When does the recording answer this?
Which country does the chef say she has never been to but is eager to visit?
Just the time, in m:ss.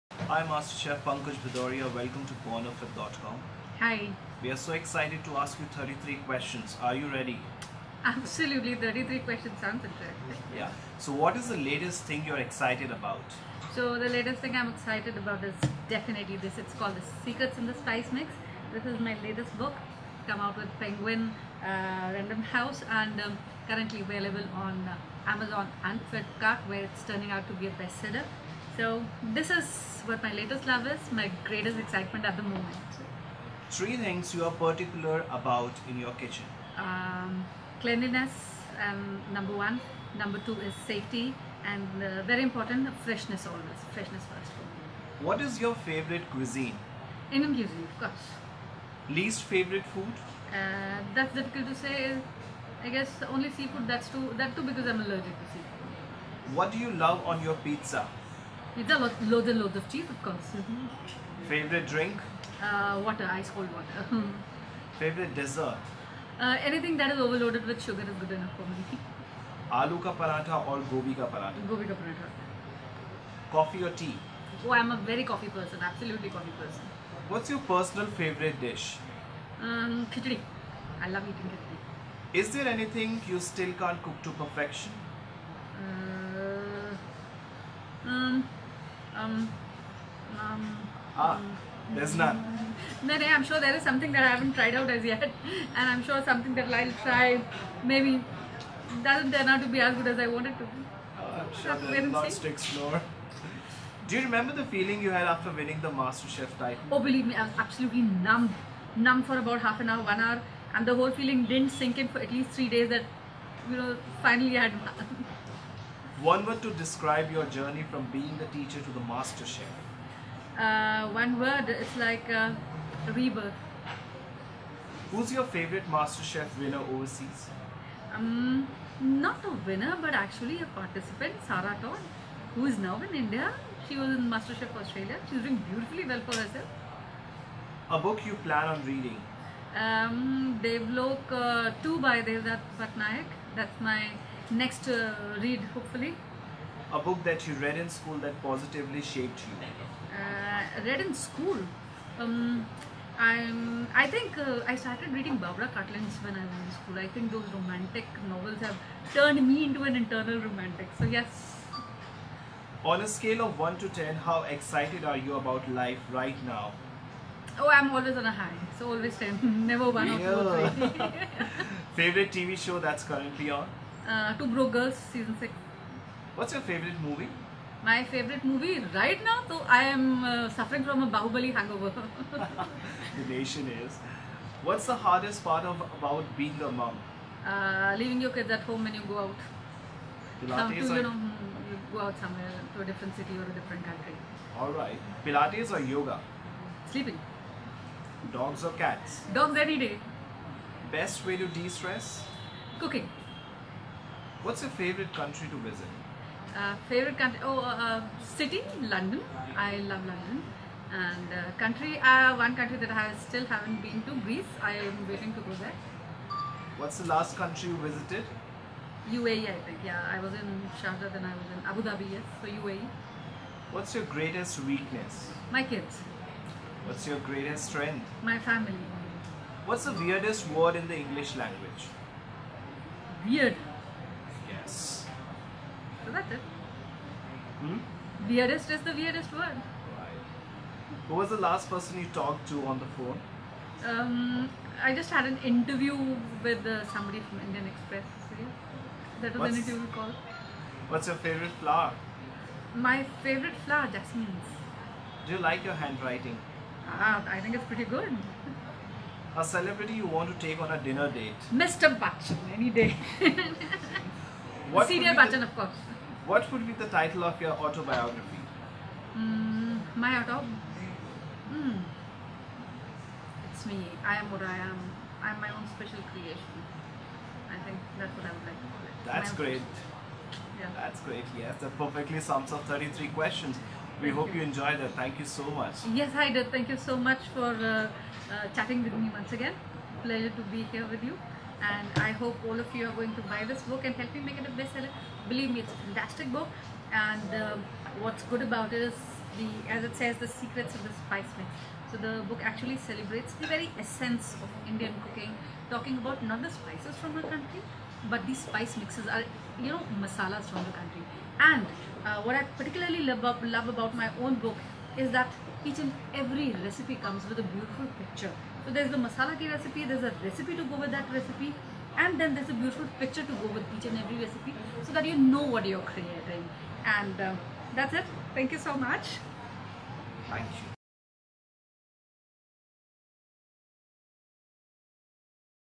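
3:34.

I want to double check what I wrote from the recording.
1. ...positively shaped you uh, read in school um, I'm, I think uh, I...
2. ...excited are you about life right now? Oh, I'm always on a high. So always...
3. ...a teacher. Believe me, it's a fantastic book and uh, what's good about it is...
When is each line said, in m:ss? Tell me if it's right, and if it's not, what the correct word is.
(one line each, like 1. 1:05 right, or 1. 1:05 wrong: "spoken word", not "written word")
1. 2:28 right
2. 2:44 right
3. 4:54 wrong: "bestseller", not "teacher".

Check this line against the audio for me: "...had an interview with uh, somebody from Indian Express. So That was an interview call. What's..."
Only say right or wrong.
right.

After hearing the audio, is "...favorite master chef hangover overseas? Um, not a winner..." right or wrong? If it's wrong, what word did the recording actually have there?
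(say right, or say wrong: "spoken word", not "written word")
wrong: "winner", not "hangover".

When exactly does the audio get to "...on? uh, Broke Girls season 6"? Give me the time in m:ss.
2:53.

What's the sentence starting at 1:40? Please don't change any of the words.
Uh, I'm sure so there's to explore.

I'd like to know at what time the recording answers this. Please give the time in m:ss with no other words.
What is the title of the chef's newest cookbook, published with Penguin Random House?
0:16.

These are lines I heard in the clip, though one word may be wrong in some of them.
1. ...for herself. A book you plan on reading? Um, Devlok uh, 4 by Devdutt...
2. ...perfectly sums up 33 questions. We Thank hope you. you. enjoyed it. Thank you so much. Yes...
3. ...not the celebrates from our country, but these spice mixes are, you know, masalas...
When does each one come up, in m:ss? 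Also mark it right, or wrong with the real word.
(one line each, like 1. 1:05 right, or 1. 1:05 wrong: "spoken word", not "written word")
1. 2:16 wrong: "2", not "4"
2. 4:41 right
3. 5:06 wrong: "spices", not "celebrates".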